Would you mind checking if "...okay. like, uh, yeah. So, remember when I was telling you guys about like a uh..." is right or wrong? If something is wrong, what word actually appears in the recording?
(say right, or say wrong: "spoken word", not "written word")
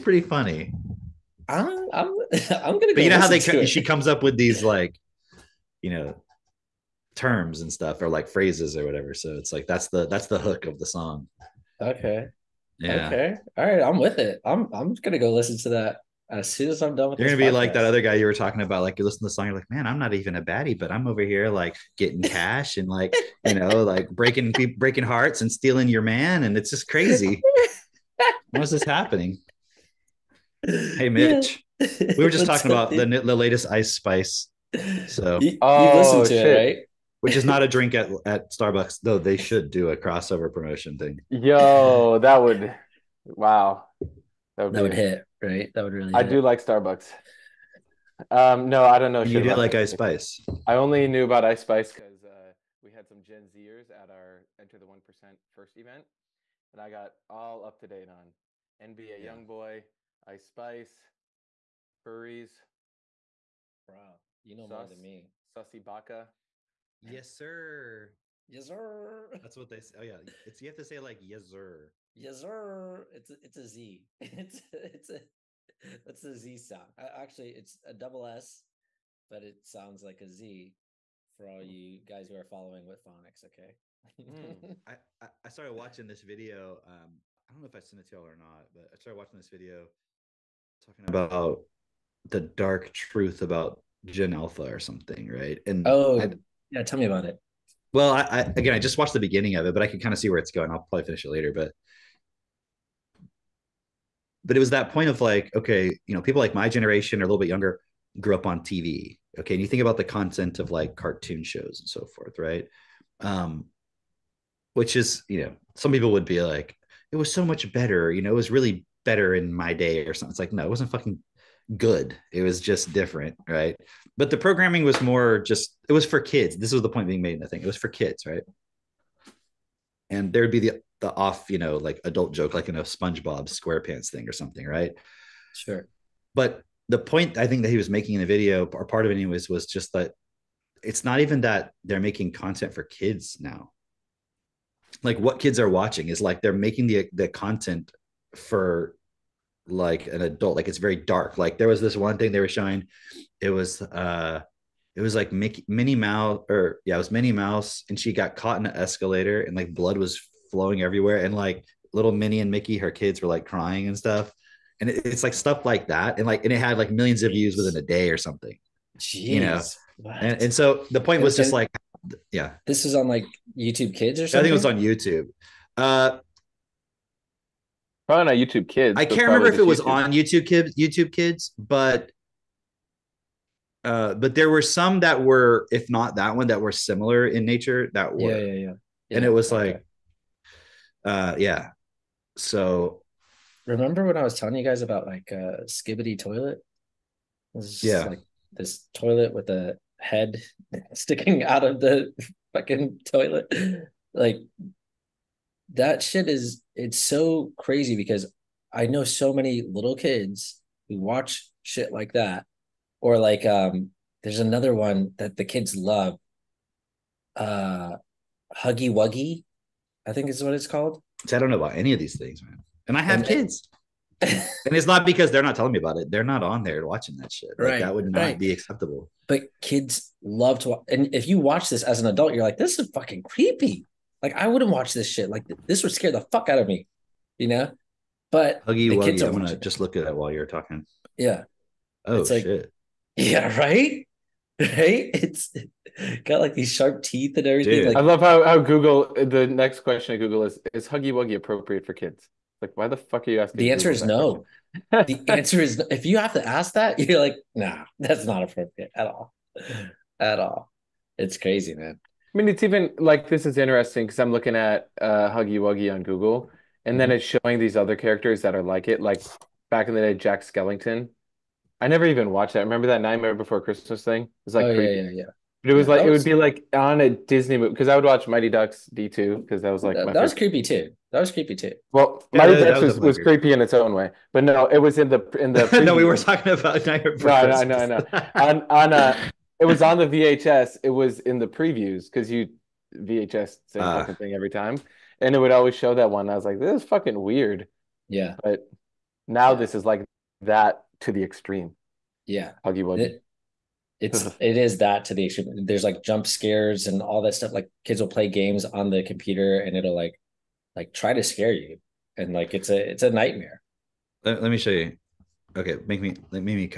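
right.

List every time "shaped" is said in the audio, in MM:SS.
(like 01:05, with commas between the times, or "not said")
not said.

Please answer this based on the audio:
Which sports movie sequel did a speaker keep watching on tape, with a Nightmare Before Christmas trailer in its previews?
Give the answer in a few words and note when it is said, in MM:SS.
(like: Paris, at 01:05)
Mighty Ducks D2, at 04:38.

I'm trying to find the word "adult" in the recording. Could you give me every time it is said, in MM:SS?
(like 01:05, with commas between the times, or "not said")
02:12, 02:30, 03:52.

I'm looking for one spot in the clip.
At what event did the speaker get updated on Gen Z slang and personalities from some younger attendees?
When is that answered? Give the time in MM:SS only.
00:54.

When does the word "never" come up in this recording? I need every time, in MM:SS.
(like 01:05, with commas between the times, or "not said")
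04:31.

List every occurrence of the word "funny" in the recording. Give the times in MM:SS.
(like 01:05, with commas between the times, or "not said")
00:00.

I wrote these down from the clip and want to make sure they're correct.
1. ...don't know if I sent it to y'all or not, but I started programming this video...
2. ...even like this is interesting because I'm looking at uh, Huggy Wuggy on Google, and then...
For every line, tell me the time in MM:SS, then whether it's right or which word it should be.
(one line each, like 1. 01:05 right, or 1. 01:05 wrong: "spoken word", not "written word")
1. 01:27 wrong: "watching", not "programming"
2. 04:22 right.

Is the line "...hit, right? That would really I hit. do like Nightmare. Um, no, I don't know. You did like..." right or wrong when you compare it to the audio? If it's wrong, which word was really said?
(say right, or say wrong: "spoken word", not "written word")
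wrong: "Starbucks", not "Nightmare".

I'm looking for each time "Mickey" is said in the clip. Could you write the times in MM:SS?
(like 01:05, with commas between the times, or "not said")
02:35, 02:42.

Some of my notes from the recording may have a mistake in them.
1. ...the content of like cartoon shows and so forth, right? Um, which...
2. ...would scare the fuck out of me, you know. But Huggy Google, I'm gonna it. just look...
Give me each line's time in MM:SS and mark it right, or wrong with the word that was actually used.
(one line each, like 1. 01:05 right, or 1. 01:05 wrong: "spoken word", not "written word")
1. 01:49 right
2. 03:55 wrong: "Wuggy", not "Google".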